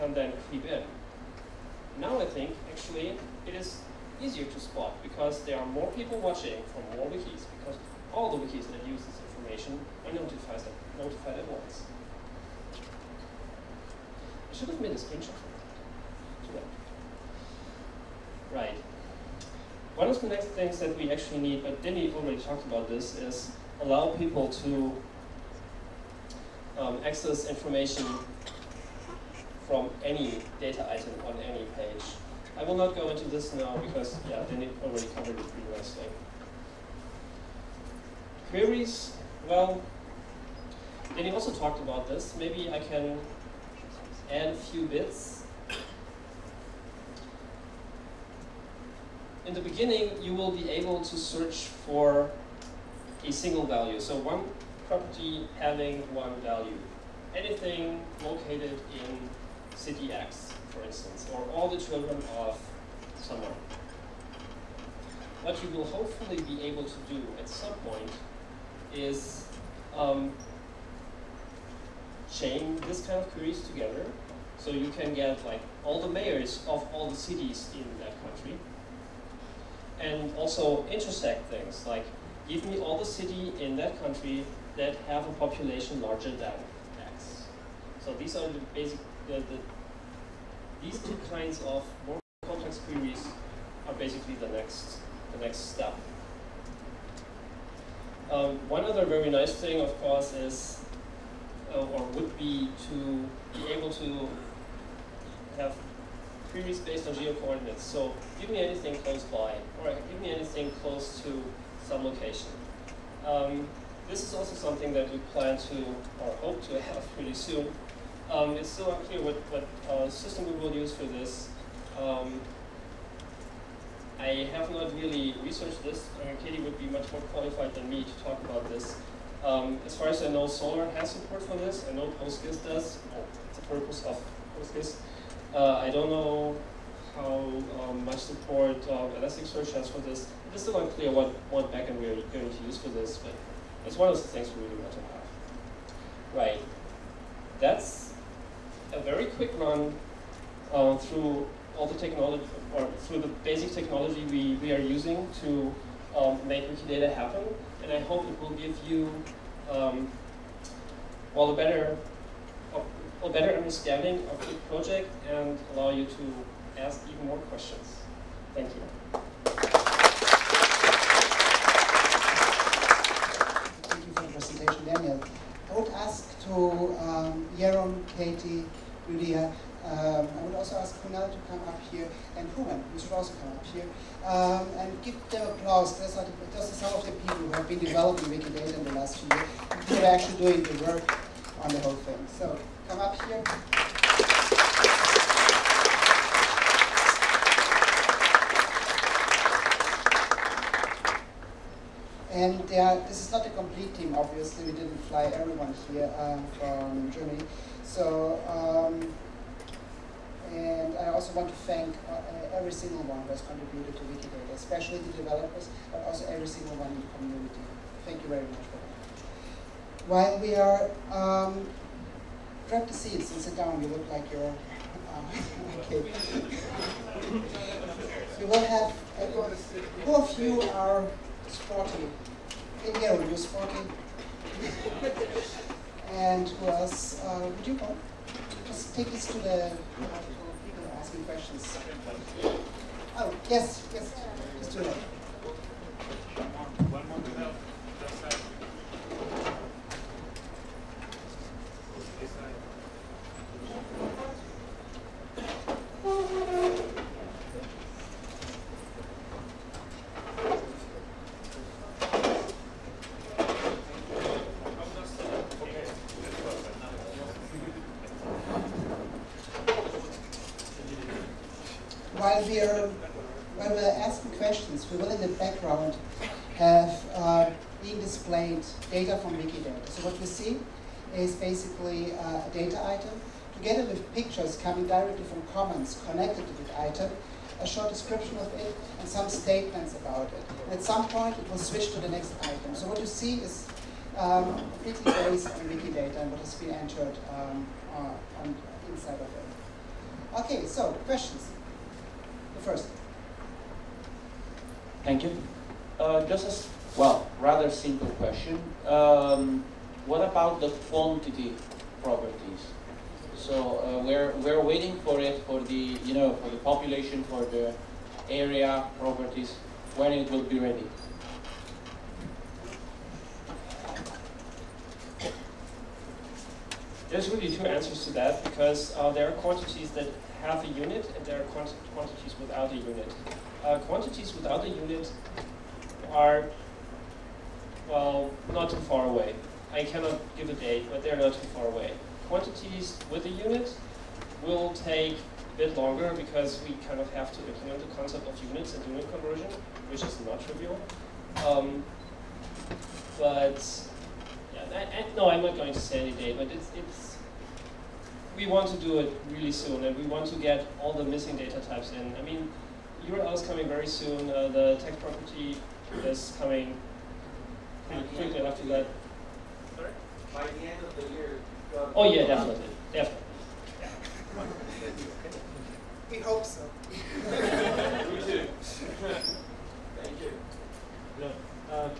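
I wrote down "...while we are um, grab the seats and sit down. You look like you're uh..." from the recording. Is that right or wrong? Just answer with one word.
right.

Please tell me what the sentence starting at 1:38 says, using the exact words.
Um, one other very nice thing, of course, is uh, or would be to be able to have previous based on geo-coordinates.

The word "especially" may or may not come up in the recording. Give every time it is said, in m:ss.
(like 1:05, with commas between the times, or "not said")
3:34.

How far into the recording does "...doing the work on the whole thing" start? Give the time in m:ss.
3:10.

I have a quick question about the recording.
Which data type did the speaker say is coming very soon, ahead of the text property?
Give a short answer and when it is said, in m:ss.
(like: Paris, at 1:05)
URL, at 6:03.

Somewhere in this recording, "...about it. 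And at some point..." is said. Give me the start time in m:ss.
4:49.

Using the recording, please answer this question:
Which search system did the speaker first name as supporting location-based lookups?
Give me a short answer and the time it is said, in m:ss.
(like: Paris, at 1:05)
Solr, at 2:10.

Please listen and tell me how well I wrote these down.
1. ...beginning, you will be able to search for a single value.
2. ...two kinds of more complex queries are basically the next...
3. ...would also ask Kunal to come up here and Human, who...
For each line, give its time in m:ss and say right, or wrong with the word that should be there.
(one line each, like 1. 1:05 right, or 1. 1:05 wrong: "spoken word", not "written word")
1. 0:49 right
2. 1:30 right
3. 3:00 right.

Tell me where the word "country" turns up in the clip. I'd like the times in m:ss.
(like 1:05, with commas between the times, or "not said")
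1:18, 1:24.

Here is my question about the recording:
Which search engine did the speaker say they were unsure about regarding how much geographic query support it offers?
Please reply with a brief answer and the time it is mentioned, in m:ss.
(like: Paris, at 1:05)
Elasticsearch, at 2:19.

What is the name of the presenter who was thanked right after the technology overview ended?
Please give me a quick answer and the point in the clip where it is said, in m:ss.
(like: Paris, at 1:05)
Daniel, at 2:54.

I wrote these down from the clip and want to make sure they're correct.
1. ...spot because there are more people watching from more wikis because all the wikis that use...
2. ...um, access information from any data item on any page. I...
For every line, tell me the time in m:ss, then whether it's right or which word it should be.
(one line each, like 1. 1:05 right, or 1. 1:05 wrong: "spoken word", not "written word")
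1. 0:04 right
2. 0:26 right.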